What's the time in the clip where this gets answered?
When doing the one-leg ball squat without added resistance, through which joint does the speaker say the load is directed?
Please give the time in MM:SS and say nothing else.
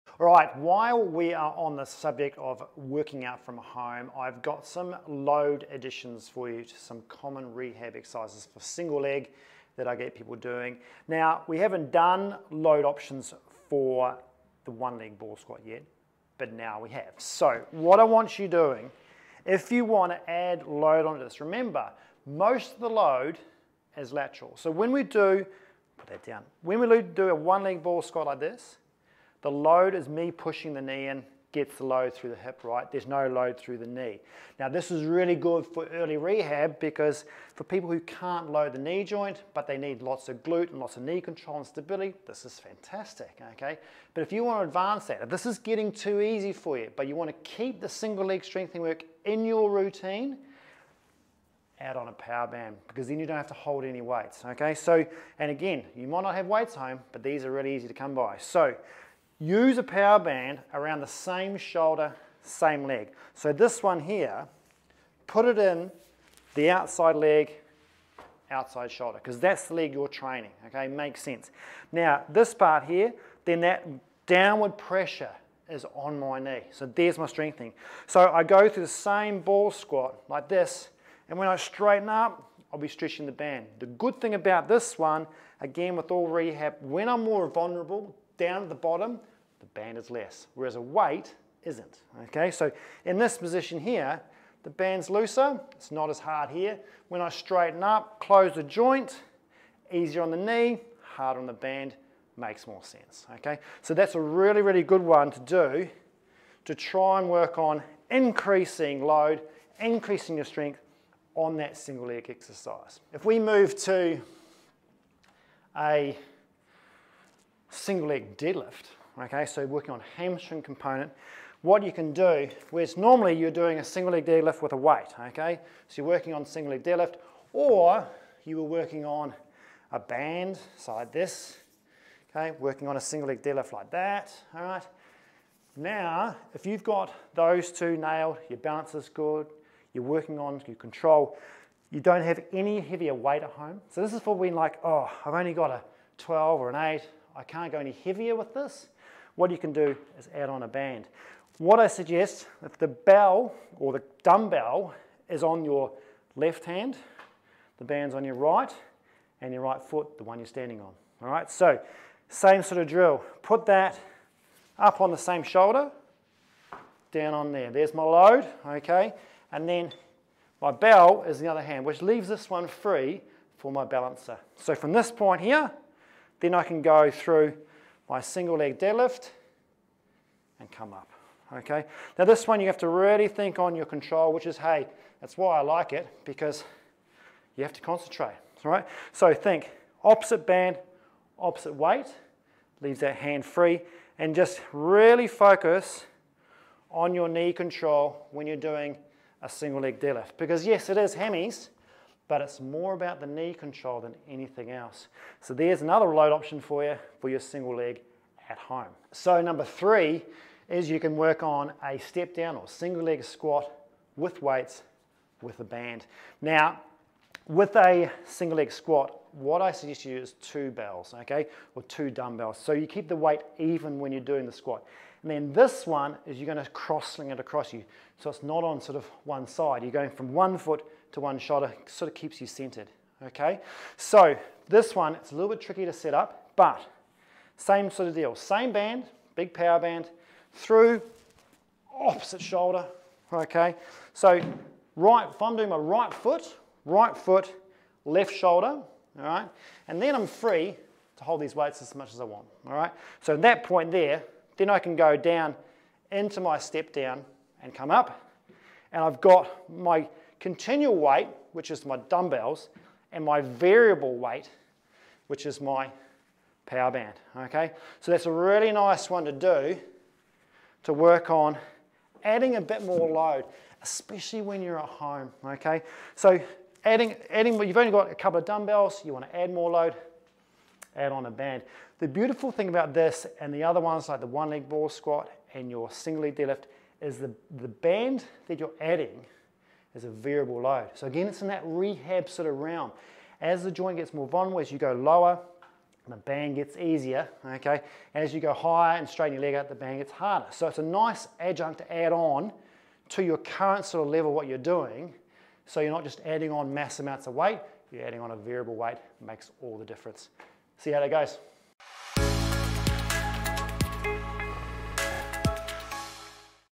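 00:32.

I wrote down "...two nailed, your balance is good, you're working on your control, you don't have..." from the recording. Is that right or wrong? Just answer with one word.
right.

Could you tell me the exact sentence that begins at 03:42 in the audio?
So you keep the weight even when you're doing the squat.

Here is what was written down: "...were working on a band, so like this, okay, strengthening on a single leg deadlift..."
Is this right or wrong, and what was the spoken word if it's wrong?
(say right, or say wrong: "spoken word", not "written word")
wrong: "working", not "strengthening".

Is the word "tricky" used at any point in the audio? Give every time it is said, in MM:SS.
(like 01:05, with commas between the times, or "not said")
03:55.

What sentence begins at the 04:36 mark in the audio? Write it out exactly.
So adding, adding, you've only got a couple of dumbbells, you wanna add more load, add on a band.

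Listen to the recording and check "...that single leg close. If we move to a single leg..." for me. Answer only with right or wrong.
wrong.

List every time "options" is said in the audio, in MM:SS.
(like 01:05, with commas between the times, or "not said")
00:12, 03:26.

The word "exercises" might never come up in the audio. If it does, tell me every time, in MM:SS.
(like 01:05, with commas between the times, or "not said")
00:07, 01:52.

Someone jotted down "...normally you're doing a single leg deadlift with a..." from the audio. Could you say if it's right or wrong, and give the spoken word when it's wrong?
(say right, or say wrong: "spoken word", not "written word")
right.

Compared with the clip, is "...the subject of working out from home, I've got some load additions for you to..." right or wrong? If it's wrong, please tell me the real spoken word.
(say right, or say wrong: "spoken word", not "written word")
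right.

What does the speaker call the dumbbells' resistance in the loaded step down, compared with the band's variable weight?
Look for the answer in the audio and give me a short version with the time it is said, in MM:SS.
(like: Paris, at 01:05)
continual weight, at 04:20.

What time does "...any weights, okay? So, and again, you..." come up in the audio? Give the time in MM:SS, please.
00:53.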